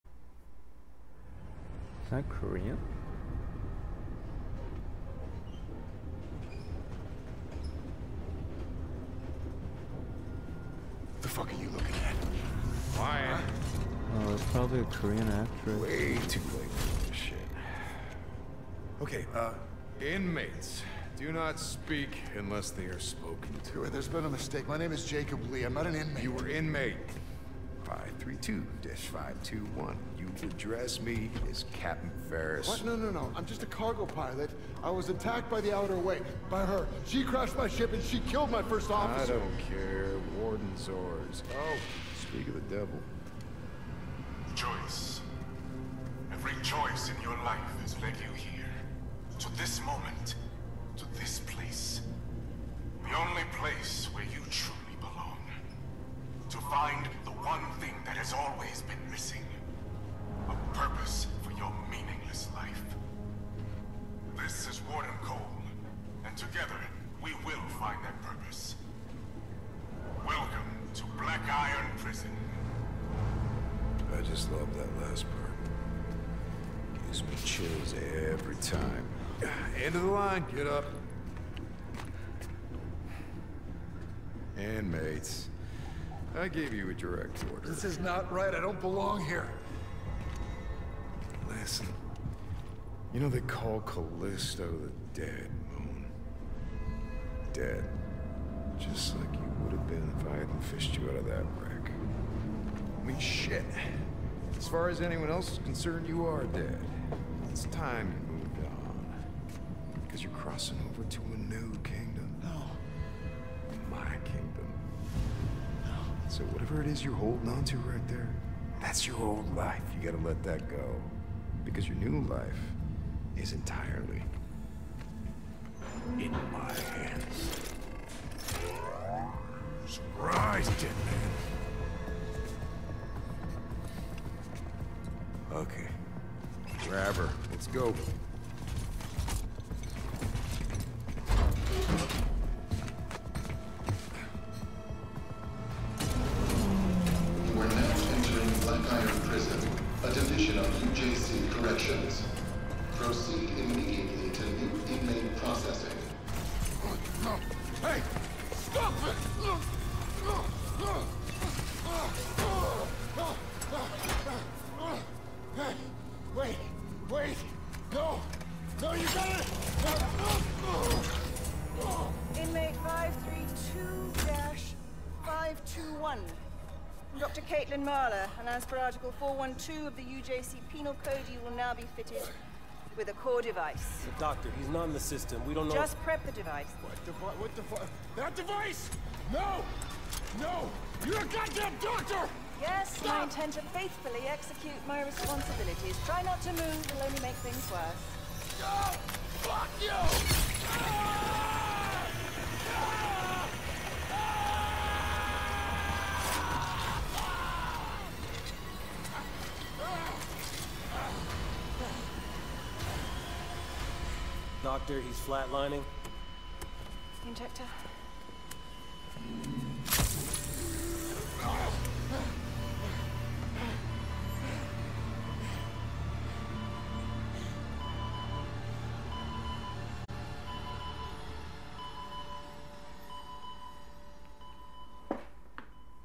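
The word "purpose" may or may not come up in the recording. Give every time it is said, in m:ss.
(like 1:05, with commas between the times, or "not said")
1:00, 1:08.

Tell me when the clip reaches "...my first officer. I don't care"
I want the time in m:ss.
0:38.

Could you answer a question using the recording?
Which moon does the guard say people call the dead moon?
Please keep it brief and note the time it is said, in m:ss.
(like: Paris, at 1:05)
Callisto, at 1:33.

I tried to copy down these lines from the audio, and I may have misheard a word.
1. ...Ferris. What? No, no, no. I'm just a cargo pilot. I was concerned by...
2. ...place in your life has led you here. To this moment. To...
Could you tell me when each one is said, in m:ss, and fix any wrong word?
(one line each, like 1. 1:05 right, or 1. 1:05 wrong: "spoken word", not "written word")
1. 0:32 wrong: "attacked", not "concerned"
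2. 0:46 wrong: "choice", not "place".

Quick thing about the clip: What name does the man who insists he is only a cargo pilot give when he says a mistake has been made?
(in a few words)
Jacob Lee.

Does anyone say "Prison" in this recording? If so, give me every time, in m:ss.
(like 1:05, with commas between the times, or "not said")
1:11, 2:29.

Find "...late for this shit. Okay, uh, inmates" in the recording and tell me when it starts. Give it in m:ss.
0:16.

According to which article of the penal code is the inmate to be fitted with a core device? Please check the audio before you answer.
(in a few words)
Article 412.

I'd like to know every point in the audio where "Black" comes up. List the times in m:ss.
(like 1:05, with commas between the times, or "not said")
1:11.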